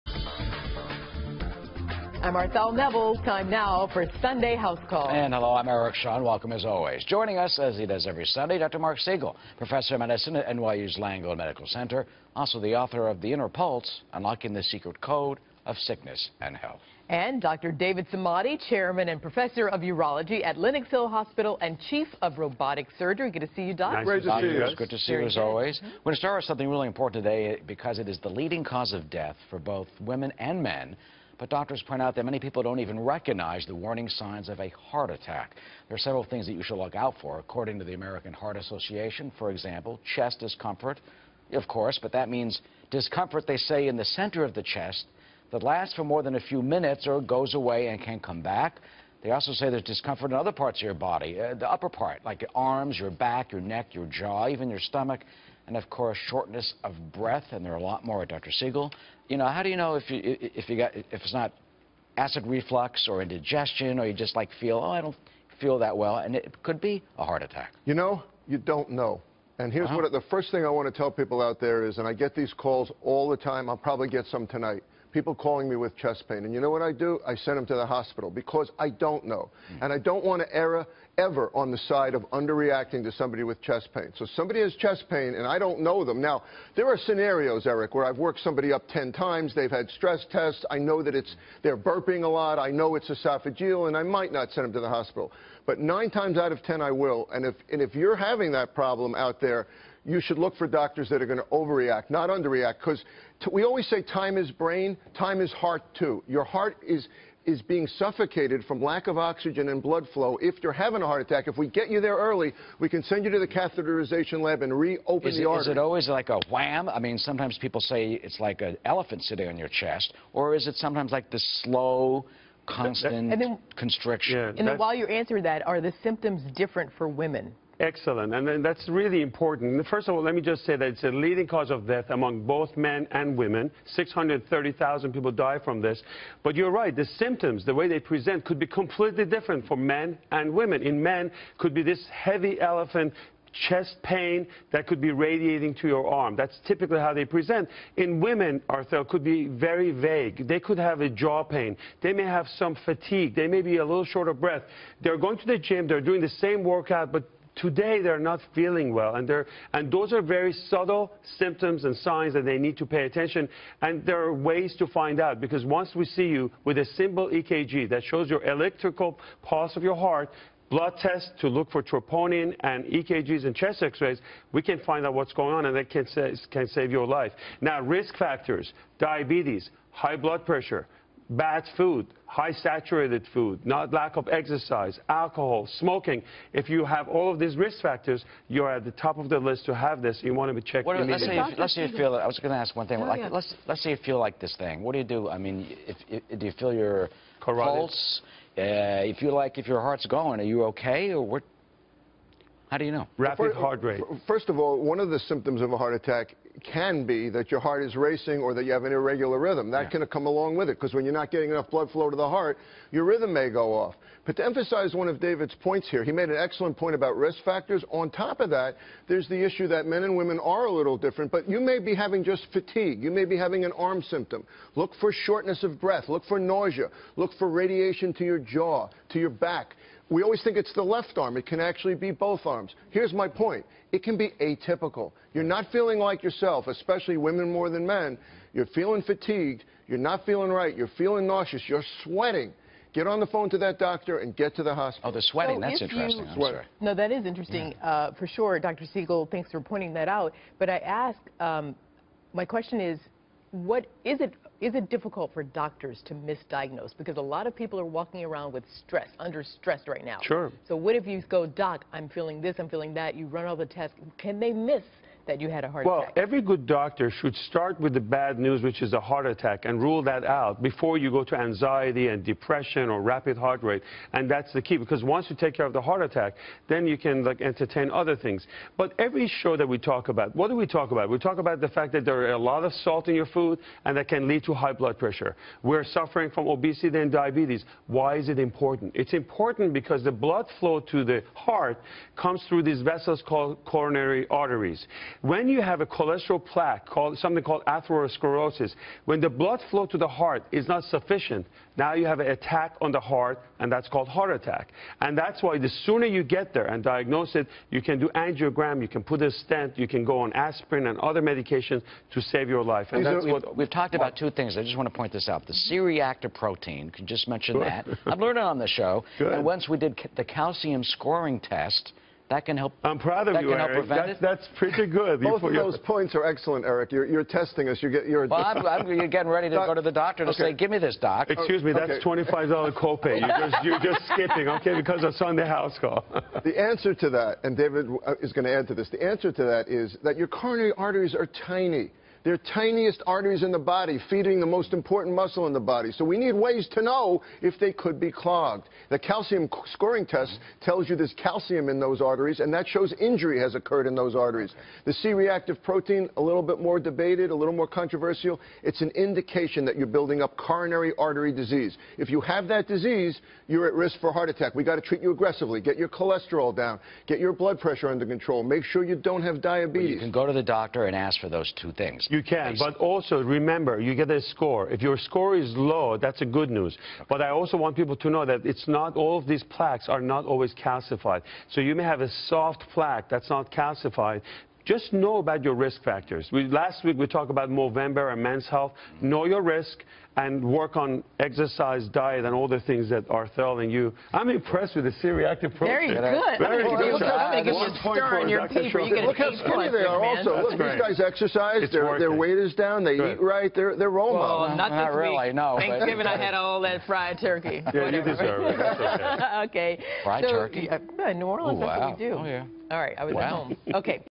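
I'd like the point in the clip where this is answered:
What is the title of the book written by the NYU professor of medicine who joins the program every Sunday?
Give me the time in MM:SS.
00:13.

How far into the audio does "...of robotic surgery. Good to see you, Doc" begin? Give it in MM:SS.
00:22.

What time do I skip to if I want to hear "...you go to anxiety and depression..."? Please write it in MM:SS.
04:30.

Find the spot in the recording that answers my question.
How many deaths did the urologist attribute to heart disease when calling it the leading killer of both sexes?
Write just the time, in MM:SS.
02:13.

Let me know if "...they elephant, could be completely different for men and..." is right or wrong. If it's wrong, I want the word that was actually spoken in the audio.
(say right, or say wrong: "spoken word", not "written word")
wrong: "present", not "elephant".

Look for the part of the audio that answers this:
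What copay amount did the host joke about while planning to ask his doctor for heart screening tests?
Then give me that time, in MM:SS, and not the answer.
05:32.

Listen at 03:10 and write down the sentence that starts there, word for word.
You want to be checked what, immediately.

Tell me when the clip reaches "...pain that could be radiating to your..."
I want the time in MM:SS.
02:24.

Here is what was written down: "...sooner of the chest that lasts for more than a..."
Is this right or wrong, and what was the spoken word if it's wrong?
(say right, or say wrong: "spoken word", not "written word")
wrong: "center", not "sooner".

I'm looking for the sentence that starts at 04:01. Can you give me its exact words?
You're sweating get on the phone to that doctor and get to the hospital.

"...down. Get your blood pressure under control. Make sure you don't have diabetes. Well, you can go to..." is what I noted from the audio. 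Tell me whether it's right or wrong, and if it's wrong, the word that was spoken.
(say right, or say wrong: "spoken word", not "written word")
right.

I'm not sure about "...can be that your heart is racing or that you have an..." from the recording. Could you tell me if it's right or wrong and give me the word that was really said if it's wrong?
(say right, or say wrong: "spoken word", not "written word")
right.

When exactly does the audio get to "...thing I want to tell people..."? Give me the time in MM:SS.
01:10.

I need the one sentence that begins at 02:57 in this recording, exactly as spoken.
Now, risk factors, diabetes, high blood pressure, bad food, high saturated food, not lack of exercise, alcohol, smoking.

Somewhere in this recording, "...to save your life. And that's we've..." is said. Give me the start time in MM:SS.
05:12.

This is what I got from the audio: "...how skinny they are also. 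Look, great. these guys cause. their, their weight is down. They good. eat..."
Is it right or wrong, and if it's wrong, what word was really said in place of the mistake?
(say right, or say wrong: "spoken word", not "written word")
wrong: "exercise", not "cause".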